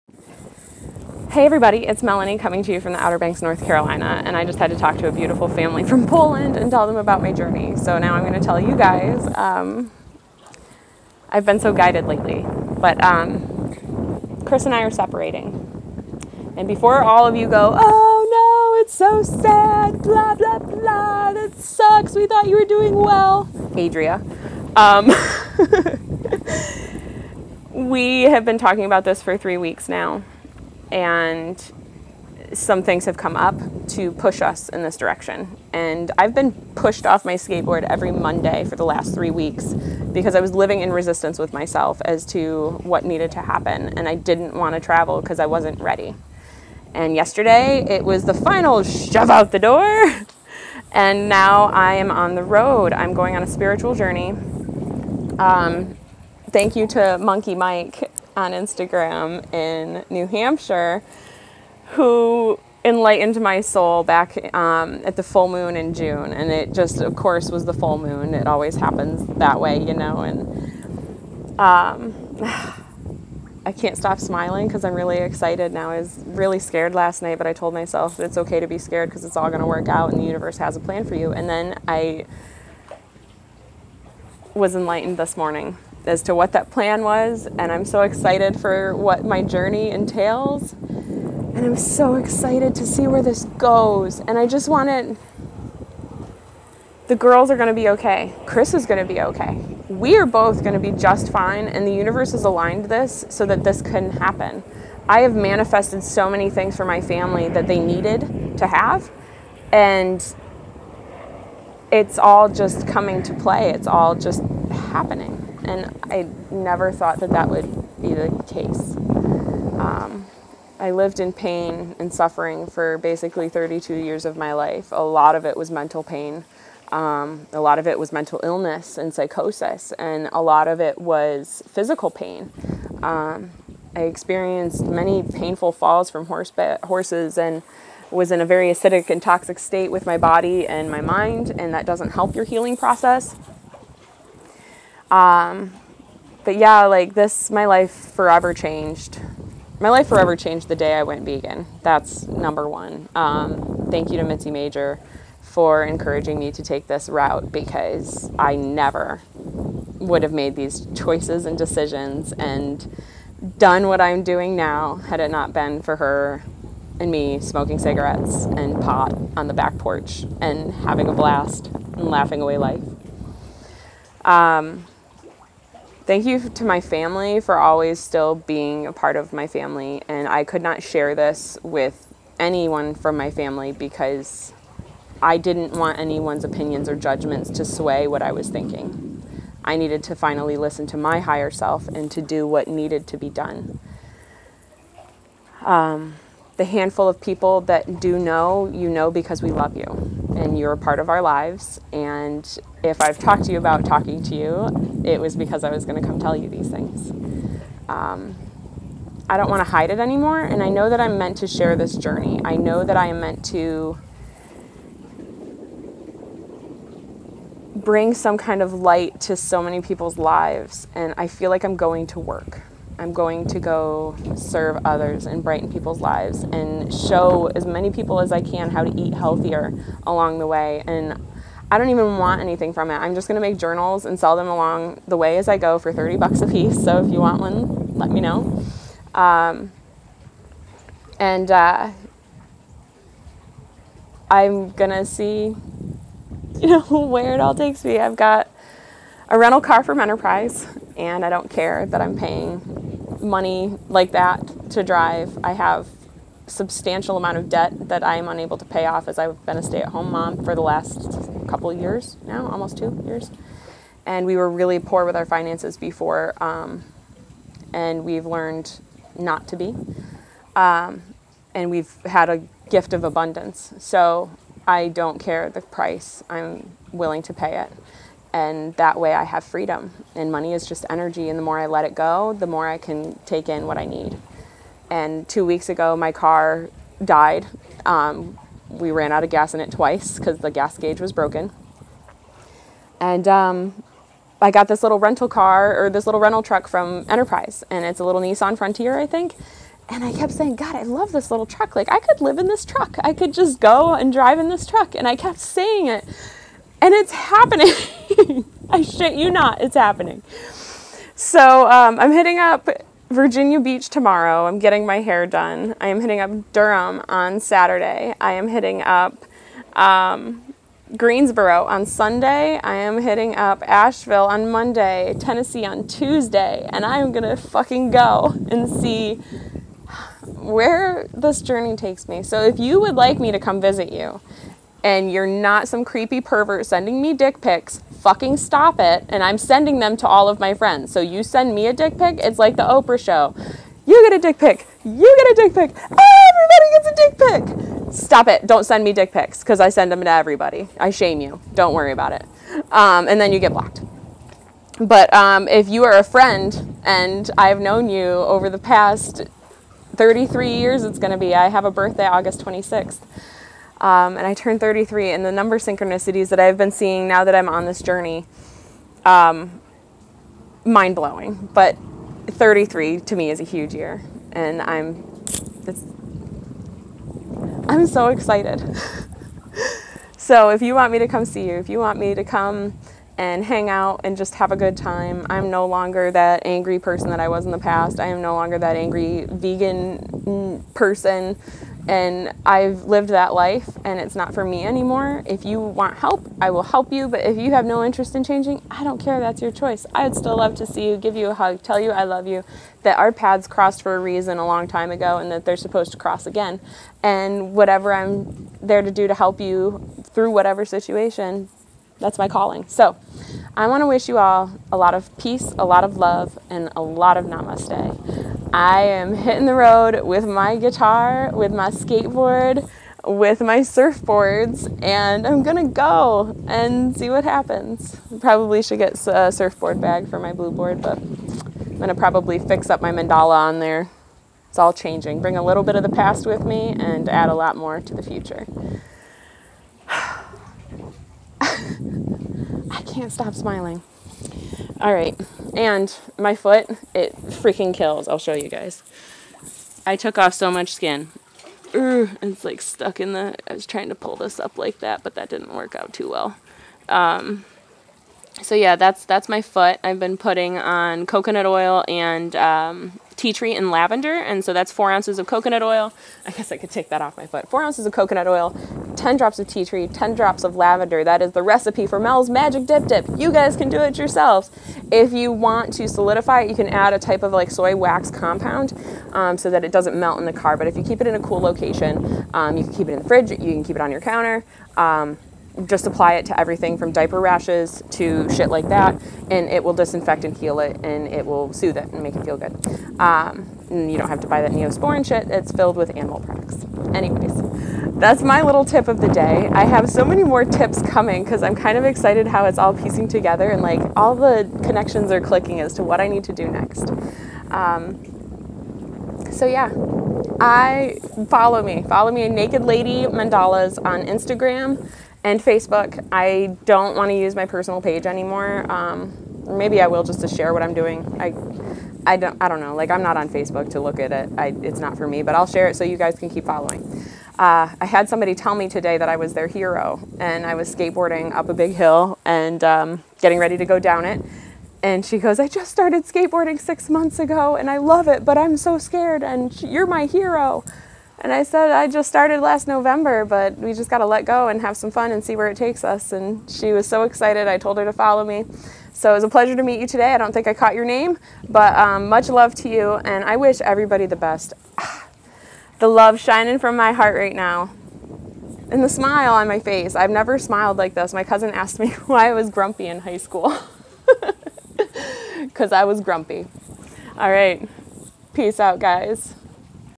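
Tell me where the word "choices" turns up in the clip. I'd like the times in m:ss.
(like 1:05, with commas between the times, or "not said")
2:40, 6:39.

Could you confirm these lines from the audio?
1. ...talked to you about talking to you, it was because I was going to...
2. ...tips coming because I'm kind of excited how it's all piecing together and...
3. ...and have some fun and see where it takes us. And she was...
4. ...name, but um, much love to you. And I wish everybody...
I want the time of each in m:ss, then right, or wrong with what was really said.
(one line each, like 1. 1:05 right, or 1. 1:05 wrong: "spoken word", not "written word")
1. 3:23 right
2. 8:20 right
3. 9:04 right
4. 9:10 right.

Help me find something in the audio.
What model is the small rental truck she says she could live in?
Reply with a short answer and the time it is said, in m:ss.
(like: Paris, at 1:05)
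Nissan Frontier, at 4:58.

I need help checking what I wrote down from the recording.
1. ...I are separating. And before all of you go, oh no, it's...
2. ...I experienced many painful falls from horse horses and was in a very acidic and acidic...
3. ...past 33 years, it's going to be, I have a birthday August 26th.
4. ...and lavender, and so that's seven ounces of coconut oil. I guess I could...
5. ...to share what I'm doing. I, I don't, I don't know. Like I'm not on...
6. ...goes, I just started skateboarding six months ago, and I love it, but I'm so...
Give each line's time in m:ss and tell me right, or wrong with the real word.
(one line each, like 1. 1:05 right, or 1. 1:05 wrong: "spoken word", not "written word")
1. 0:14 right
2. 2:13 wrong: "toxic", not "acidic"
3. 5:58 right
4. 7:43 wrong: "four", not "seven"
5. 8:40 right
6. 8:55 right.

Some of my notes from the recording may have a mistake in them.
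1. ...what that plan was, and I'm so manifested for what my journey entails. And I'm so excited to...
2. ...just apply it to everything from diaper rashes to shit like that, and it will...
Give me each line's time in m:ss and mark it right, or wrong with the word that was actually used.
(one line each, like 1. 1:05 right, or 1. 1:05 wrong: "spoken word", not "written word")
1. 1:26 wrong: "excited", not "manifested"
2. 8:05 right.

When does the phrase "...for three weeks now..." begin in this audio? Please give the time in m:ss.
0:29.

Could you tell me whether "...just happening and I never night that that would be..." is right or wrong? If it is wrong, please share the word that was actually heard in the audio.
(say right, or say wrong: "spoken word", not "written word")
wrong: "thought", not "night".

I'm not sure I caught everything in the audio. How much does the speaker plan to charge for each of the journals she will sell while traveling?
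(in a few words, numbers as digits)
30 bucks.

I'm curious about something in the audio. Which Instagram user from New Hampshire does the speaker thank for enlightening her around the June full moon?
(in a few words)
Monkey Mike.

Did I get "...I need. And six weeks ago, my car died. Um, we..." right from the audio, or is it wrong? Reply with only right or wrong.
wrong.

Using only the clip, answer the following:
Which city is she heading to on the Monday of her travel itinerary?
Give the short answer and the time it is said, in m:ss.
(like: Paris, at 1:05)
Asheville, at 5:23.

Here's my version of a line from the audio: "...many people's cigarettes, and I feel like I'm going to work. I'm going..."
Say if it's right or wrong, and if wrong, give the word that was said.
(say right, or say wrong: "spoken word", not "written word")
wrong: "lives", not "cigarettes".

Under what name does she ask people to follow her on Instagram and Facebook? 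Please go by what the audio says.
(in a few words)
Naked Lady Mandalas.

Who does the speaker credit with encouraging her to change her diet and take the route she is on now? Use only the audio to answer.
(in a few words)
Mitzi Major.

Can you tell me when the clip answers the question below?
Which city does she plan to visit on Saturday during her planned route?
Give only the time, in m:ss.
5:16.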